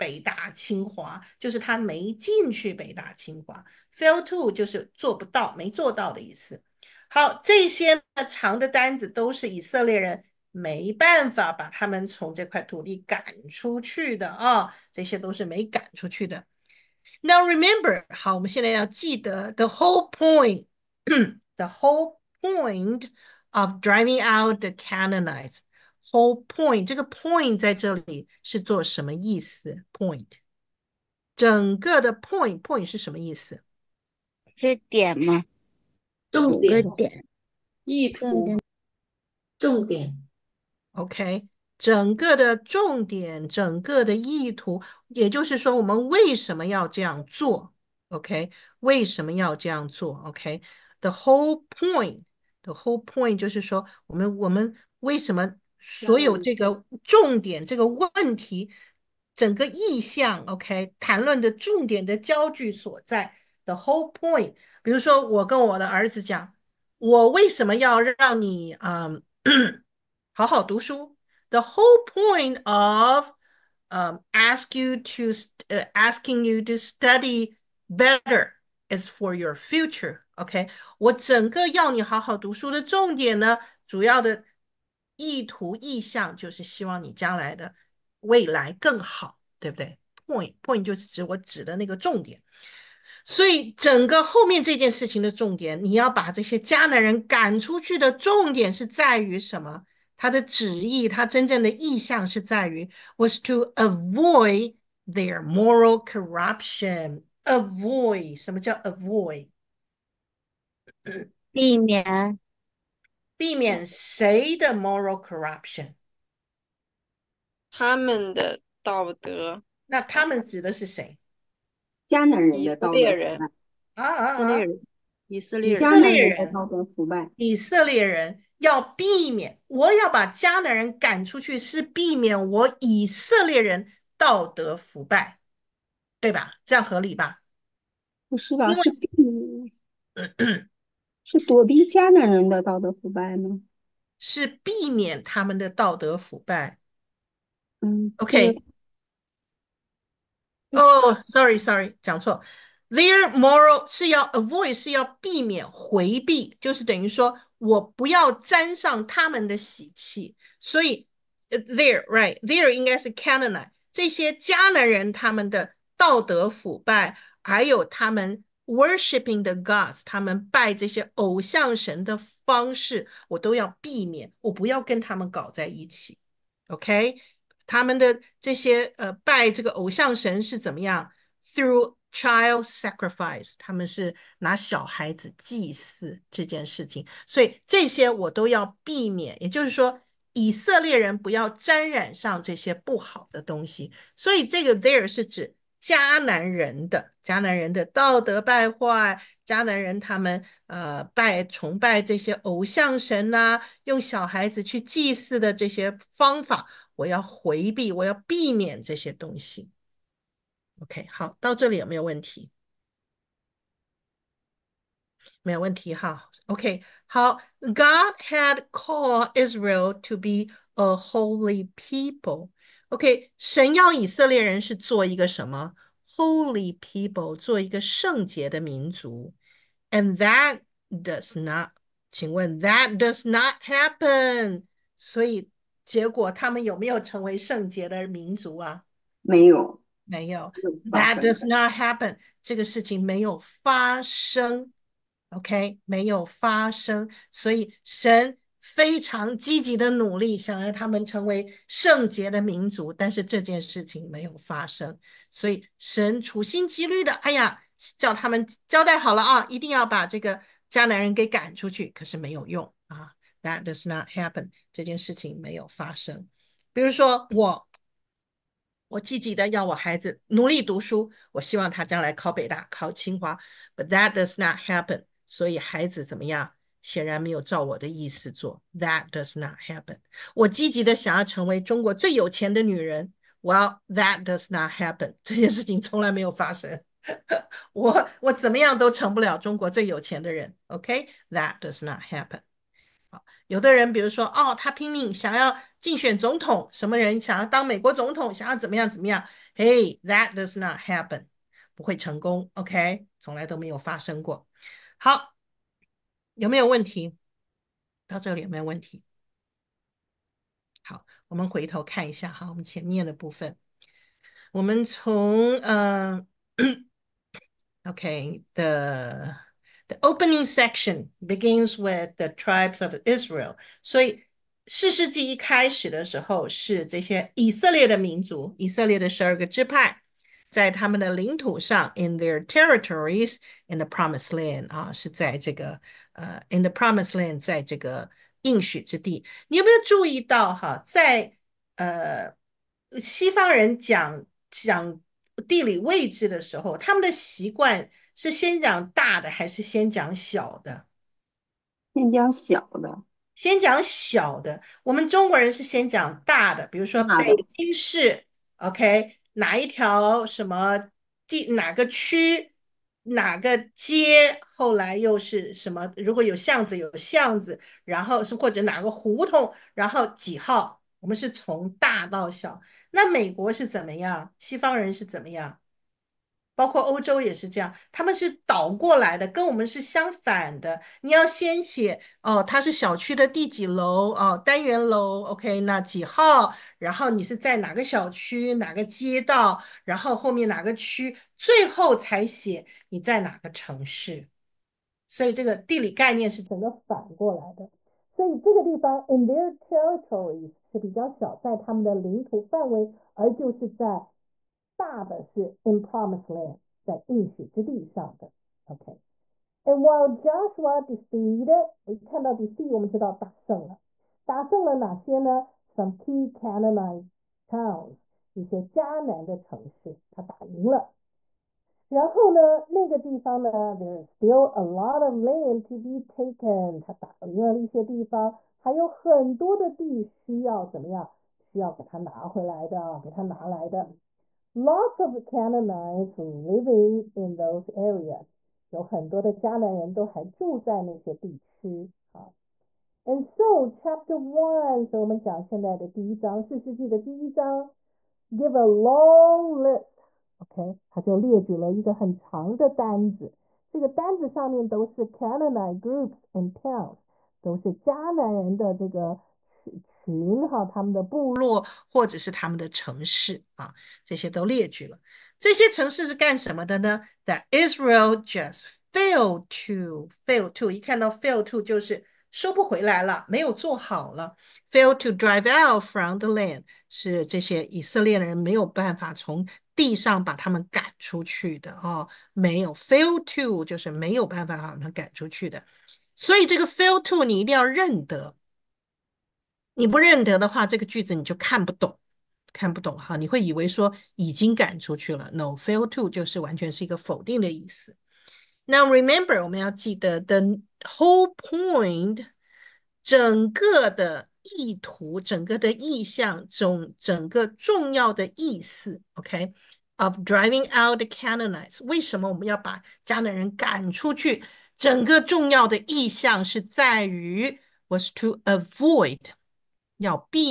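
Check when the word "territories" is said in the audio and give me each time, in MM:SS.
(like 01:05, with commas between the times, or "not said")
05:32, 06:39.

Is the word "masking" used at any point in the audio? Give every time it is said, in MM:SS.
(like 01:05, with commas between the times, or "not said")
not said.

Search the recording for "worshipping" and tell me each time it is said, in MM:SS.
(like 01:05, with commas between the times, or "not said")
02:48.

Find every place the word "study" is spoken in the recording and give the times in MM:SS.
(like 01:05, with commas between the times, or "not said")
01:16.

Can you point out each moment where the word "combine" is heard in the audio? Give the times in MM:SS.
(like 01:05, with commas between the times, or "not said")
not said.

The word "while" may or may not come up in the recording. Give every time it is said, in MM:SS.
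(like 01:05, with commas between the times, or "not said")
06:49.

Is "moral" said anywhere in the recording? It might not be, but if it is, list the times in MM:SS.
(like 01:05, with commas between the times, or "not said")
01:45, 01:54, 02:33.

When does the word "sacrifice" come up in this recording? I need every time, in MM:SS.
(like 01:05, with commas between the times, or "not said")
03:02.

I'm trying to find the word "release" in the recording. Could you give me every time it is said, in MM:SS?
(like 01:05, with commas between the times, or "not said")
not said.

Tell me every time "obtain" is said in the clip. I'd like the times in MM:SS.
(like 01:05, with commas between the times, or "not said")
not said.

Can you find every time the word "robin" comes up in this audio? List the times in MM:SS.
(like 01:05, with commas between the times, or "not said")
not said.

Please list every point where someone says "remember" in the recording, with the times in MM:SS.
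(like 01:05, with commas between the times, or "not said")
00:17, 08:18.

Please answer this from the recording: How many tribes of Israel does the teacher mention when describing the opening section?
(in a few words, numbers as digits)
12.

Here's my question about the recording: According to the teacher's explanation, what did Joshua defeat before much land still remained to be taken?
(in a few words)
key Canaanite towns.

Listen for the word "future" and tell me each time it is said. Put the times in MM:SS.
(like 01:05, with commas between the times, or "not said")
01:19.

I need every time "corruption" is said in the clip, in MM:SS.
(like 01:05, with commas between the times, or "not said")
01:46, 01:55.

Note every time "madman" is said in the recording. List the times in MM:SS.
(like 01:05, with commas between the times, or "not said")
not said.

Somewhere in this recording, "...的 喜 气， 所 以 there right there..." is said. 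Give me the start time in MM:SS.
02:39.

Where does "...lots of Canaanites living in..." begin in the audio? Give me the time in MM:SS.
07:14.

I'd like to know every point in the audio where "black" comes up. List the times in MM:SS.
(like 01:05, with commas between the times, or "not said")
not said.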